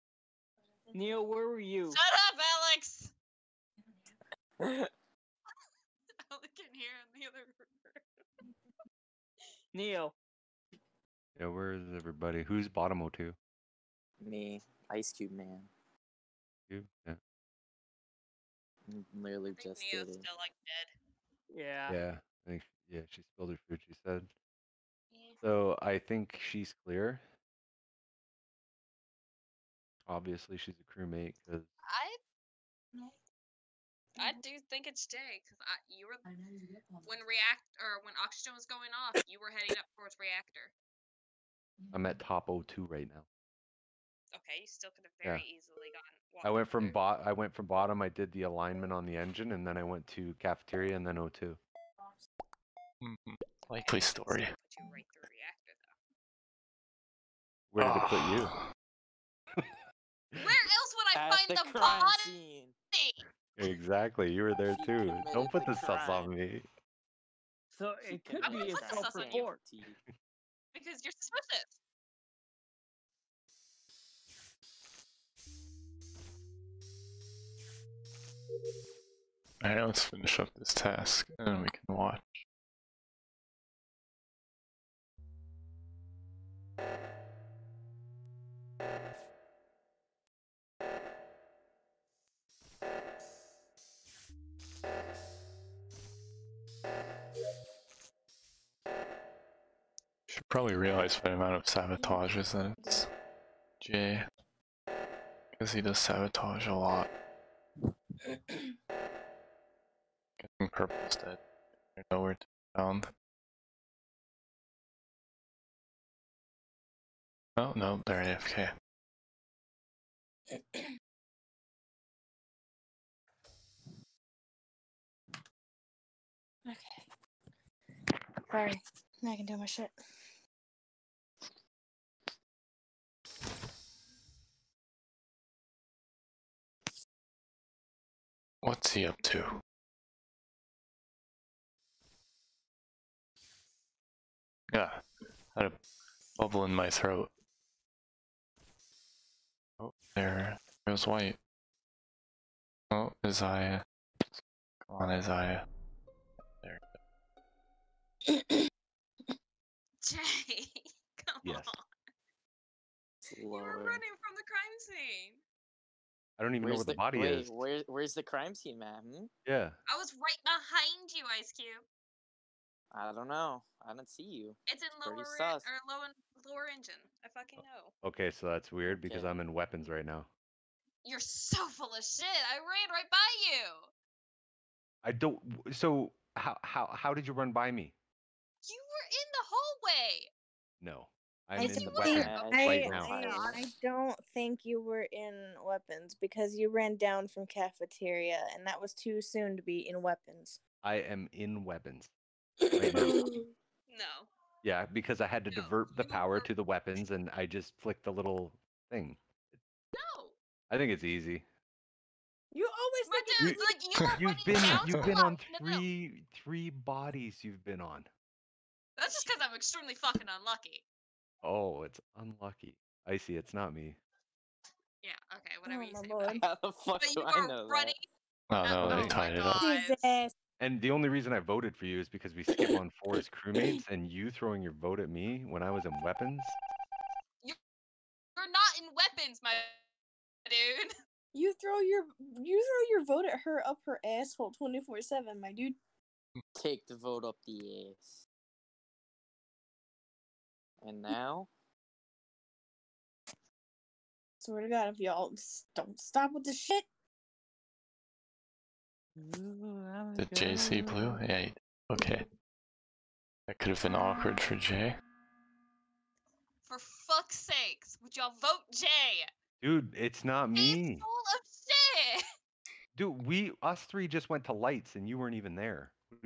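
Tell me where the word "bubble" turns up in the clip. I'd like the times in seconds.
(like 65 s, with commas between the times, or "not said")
146 s.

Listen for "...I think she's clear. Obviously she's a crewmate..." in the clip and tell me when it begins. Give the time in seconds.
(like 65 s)
25 s.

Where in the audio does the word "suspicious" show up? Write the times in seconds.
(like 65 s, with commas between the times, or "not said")
71 s.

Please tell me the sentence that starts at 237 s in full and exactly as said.
You're not in weapons, my dude.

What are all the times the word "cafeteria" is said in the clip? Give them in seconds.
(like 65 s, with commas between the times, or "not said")
50 s, 197 s.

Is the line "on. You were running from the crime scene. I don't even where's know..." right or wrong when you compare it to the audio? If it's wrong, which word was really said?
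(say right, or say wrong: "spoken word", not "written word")
right.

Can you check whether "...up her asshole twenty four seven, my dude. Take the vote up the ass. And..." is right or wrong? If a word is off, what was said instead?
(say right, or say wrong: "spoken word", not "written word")
right.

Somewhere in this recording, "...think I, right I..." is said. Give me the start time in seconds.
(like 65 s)
192 s.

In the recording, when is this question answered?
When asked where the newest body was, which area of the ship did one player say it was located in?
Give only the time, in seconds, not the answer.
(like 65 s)
176 s.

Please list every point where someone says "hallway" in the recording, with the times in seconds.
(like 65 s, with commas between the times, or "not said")
190 s.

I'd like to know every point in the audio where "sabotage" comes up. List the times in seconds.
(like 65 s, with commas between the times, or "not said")
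101 s, 105 s.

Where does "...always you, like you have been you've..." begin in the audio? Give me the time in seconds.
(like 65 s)
212 s.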